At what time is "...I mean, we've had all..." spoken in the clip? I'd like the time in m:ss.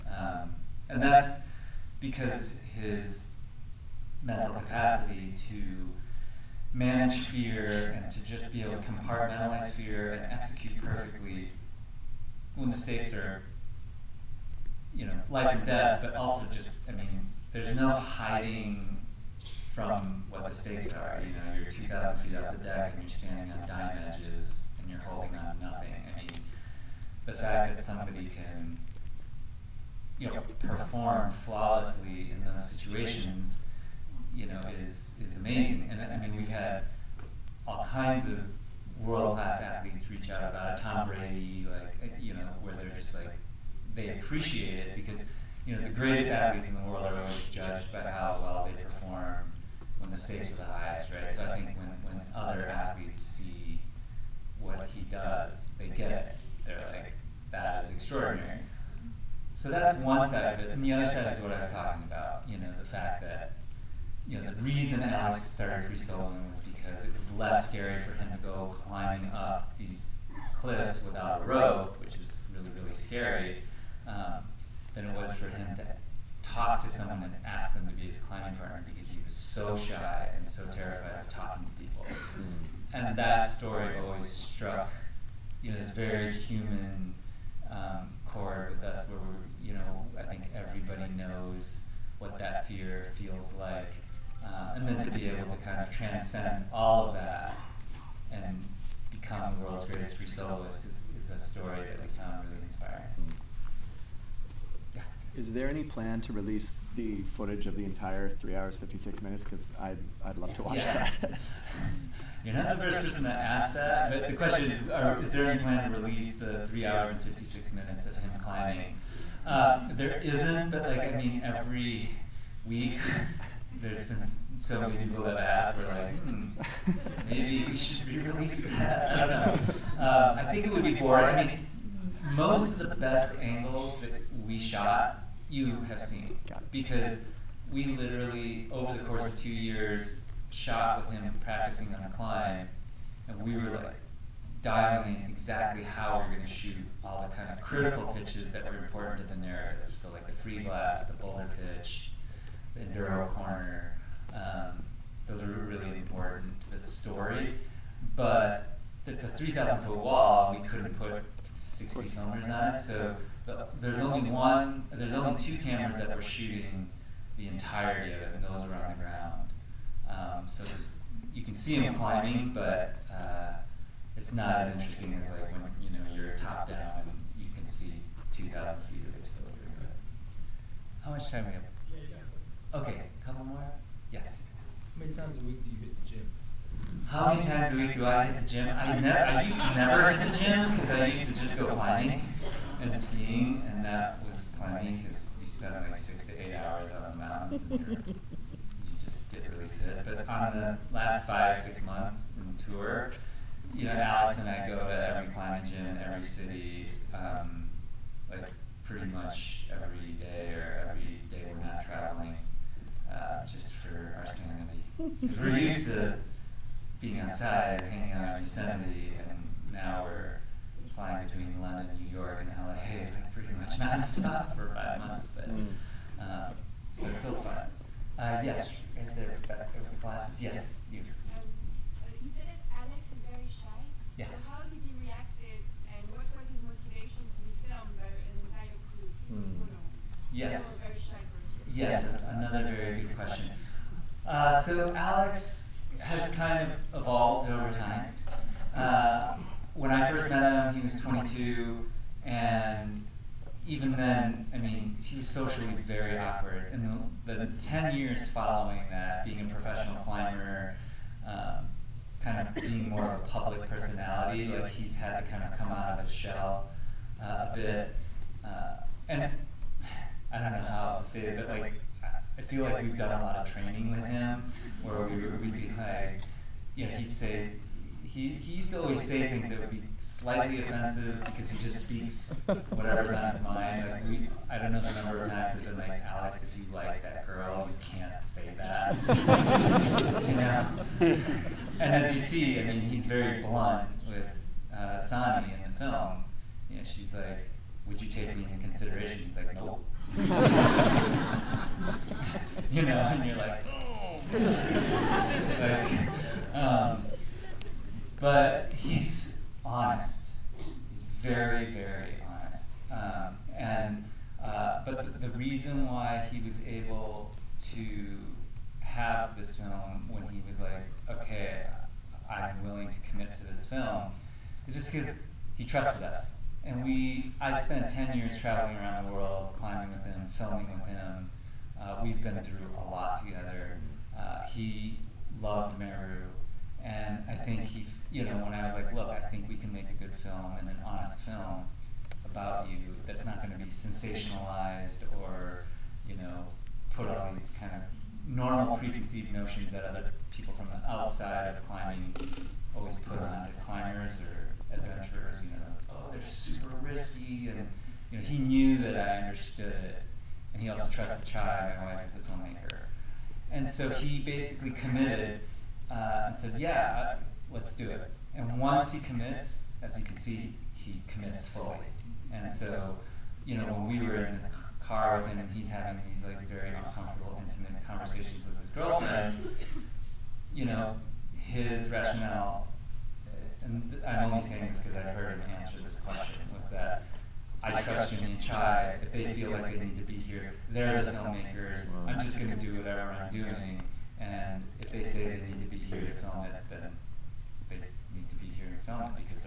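0:35.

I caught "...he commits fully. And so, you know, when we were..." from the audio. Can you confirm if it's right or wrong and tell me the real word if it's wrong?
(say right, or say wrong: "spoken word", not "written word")
right.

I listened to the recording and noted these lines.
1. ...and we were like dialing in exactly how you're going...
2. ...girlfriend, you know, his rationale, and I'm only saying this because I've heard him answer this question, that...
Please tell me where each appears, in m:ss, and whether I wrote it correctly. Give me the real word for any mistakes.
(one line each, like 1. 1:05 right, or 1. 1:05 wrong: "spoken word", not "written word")
1. 2:23 right
2. 6:18 right.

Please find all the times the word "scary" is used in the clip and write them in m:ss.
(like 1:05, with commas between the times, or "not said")
1:07, 1:12.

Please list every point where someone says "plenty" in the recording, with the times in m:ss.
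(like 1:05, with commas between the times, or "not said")
not said.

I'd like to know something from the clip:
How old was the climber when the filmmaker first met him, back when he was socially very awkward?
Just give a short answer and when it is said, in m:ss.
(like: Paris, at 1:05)
22, at 4:11.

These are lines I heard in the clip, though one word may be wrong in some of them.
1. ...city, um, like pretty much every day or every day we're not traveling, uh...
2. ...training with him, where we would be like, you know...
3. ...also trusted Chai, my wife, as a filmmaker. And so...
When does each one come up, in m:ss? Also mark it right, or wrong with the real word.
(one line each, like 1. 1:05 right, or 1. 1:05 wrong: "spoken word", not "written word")
1. 3:26 right
2. 4:33 right
3. 6:00 right.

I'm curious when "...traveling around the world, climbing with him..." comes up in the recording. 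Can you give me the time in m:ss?
5:28.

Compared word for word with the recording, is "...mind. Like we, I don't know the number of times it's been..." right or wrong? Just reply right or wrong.
right.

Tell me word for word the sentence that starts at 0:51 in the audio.
So I think when, when other athletes see what he does, they get it.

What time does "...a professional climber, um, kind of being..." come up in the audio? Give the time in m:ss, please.
4:19.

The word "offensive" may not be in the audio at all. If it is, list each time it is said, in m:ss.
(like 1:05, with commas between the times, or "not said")
4:40.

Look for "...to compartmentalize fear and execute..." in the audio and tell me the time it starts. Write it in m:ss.
0:08.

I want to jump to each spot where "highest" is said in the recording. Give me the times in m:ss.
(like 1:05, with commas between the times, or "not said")
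0:50.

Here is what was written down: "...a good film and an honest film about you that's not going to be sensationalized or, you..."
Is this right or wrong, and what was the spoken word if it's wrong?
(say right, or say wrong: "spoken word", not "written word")
right.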